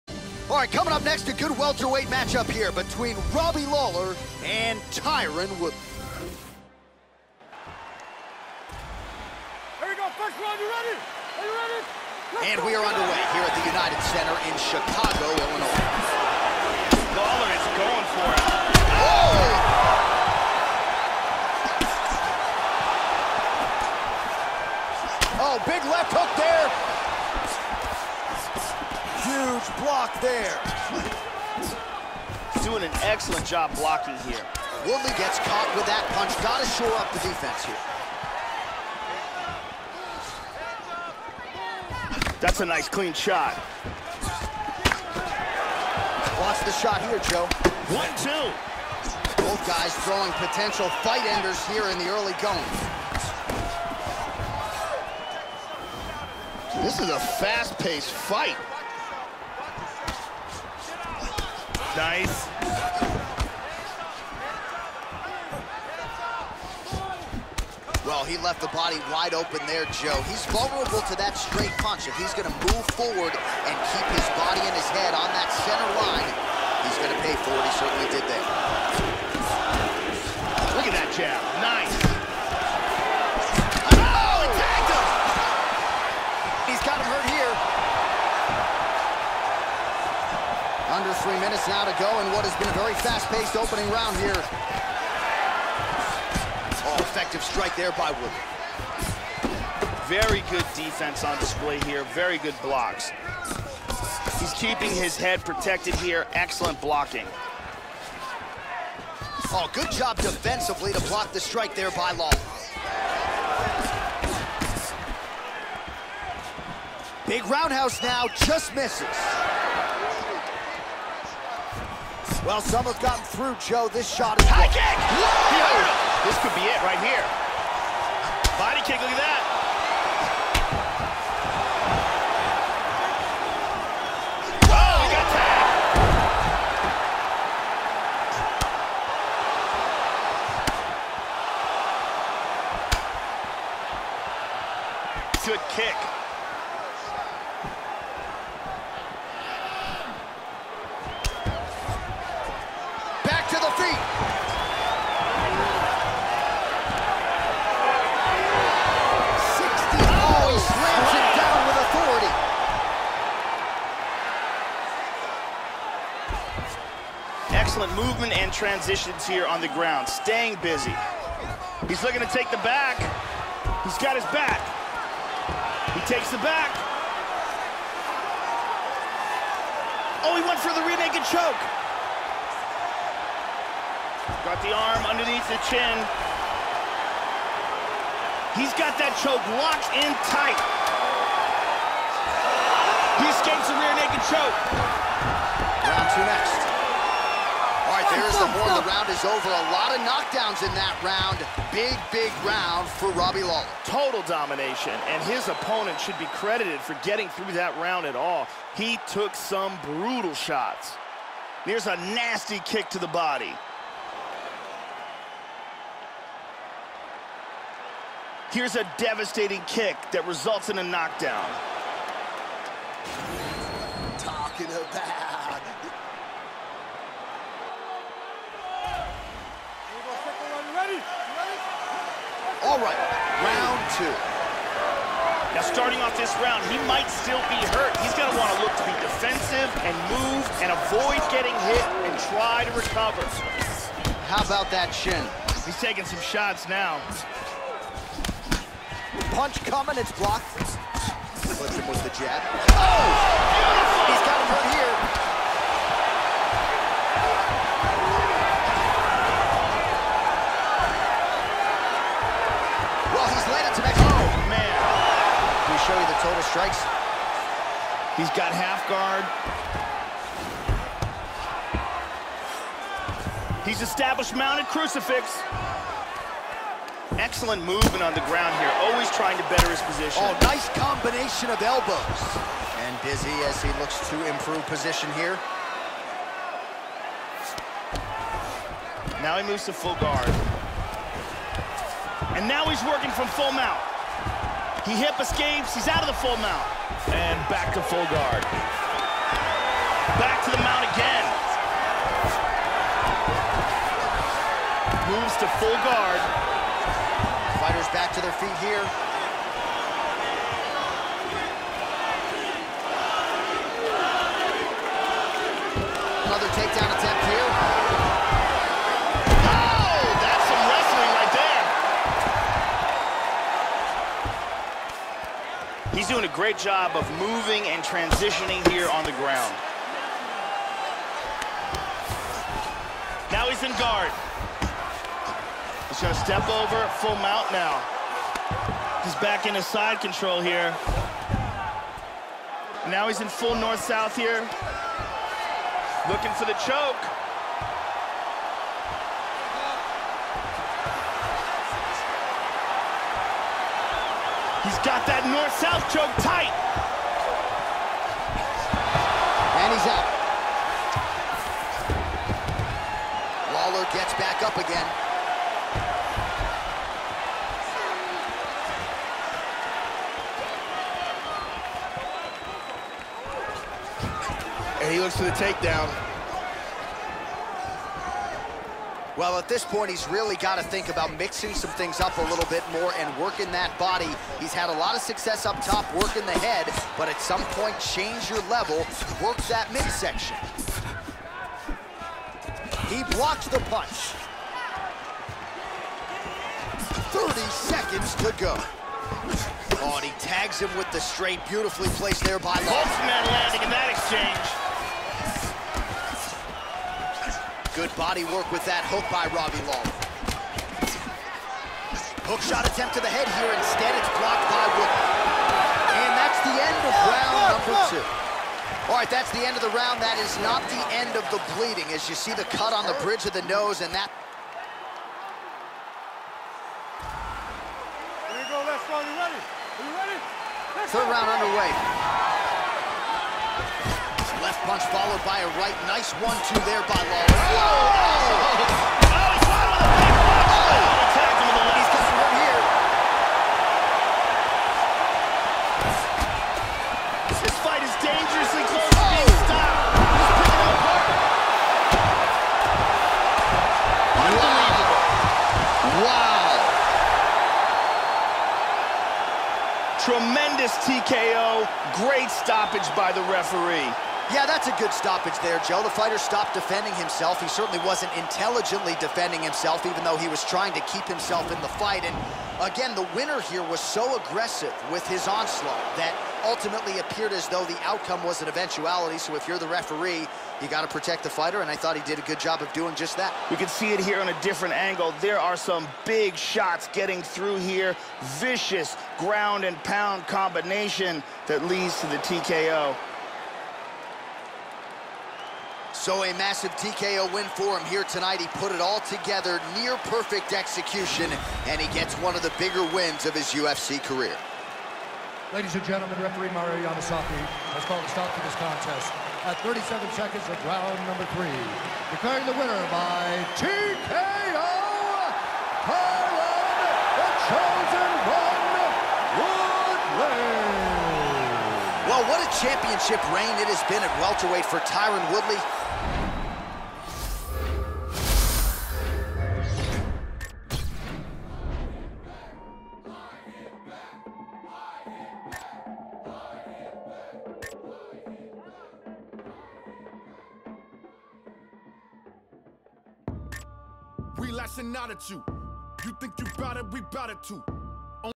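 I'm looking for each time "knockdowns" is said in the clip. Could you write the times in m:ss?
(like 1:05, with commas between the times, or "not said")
3:20, 3:40.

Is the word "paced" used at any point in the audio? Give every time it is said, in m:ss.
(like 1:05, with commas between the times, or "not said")
0:57, 1:33.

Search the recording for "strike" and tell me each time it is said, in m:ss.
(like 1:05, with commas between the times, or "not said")
1:37, 1:51, 4:26.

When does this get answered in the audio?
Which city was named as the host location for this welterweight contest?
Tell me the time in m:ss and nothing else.
0:14.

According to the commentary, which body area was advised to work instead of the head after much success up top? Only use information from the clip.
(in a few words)
midsection.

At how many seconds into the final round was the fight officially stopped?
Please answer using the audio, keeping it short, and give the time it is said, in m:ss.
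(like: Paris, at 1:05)
37, at 8:29.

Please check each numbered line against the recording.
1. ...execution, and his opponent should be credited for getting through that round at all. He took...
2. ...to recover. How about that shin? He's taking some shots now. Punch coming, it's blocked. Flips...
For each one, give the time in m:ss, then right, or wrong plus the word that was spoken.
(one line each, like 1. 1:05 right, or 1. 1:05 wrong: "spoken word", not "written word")
1. 3:24 wrong: "domination", not "execution"
2. 4:02 right.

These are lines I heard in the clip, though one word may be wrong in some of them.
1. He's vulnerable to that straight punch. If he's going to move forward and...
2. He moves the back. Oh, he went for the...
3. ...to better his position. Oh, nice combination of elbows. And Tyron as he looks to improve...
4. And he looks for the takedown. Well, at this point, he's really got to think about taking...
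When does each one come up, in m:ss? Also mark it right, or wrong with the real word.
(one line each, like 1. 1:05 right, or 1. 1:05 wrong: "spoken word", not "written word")
1. 1:10 right
2. 2:55 wrong: "takes", not "moves"
3. 4:39 wrong: "Dizzy", not "Tyron"
4. 6:14 wrong: "mixing", not "taking".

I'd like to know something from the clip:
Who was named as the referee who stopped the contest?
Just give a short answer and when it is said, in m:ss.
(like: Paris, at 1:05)
Mario Yamasaki, at 8:26.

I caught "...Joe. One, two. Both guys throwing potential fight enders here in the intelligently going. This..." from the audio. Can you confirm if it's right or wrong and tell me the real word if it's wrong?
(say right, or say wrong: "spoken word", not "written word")
wrong: "early", not "intelligently".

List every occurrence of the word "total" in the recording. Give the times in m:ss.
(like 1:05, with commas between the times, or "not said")
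3:23, 4:26.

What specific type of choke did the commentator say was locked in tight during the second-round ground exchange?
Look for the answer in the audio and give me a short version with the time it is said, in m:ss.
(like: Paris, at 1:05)
north-south choke, at 5:55.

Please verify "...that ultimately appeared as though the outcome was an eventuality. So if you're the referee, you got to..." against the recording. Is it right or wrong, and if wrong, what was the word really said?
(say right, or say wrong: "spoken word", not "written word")
right.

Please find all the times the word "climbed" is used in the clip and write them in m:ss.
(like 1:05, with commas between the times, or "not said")
not said.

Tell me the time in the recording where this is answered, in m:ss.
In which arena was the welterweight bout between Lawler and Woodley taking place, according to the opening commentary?
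0:13.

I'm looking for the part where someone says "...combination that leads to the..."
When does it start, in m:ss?
8:10.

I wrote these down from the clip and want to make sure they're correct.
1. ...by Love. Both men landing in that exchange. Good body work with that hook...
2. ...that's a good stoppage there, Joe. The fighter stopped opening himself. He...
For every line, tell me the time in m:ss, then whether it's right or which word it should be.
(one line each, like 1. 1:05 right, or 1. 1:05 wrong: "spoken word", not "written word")
1. 6:42 right
2. 7:44 wrong: "defending", not "opening".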